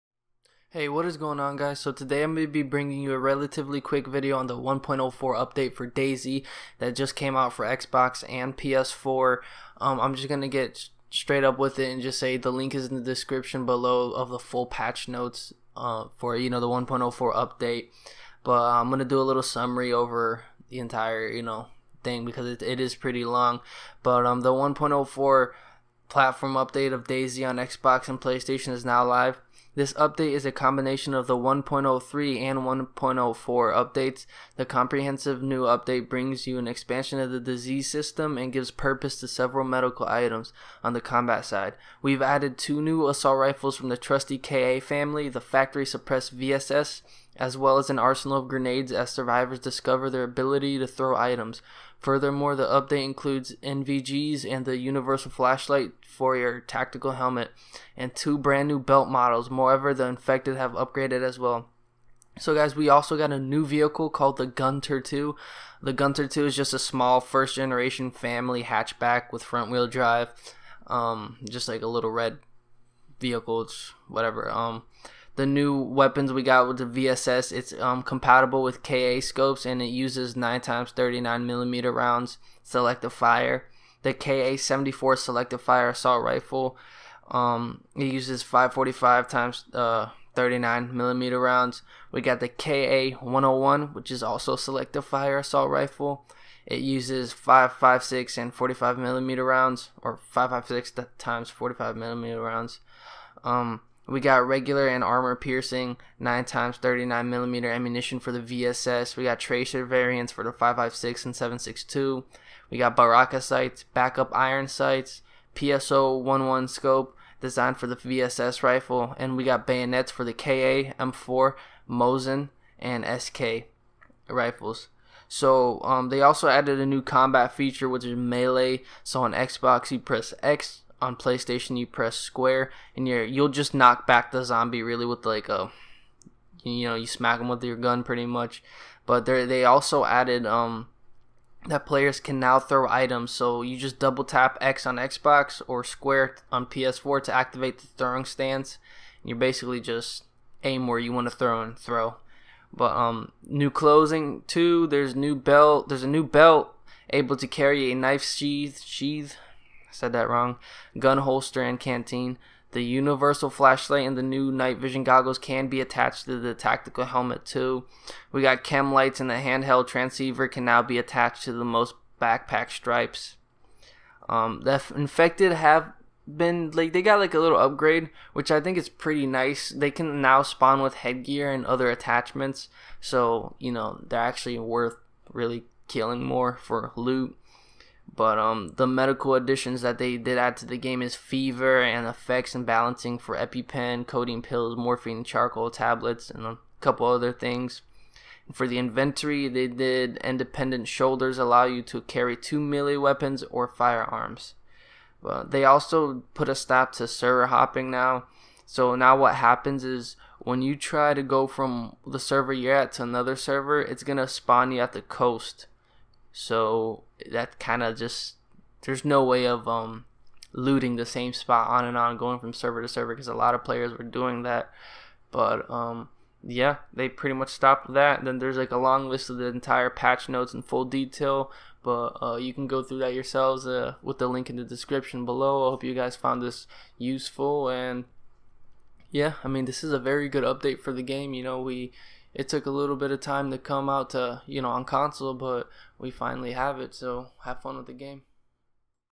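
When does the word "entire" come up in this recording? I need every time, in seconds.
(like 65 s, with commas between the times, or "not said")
20 s, 229 s.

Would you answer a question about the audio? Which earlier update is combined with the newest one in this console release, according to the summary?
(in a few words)
1.03.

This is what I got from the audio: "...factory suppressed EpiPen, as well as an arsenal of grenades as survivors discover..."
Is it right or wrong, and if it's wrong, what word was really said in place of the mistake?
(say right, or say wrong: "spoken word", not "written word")
wrong: "VSS", not "EpiPen".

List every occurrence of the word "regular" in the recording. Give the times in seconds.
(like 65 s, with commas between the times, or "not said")
104 s.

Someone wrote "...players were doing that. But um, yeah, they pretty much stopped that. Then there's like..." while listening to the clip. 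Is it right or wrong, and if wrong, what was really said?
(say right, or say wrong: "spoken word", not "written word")
right.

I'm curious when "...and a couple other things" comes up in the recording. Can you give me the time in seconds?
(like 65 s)
196 s.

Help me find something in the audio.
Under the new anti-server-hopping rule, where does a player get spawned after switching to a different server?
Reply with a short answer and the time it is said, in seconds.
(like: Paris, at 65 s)
At the coast, at 214 s.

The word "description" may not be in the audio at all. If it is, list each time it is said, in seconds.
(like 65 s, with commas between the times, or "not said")
13 s, 234 s.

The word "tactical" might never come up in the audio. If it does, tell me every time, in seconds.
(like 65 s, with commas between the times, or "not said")
56 s, 166 s.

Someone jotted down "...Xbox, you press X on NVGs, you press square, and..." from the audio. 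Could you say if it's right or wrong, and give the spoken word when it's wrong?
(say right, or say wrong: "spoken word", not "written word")
wrong: "PlayStation", not "NVGs".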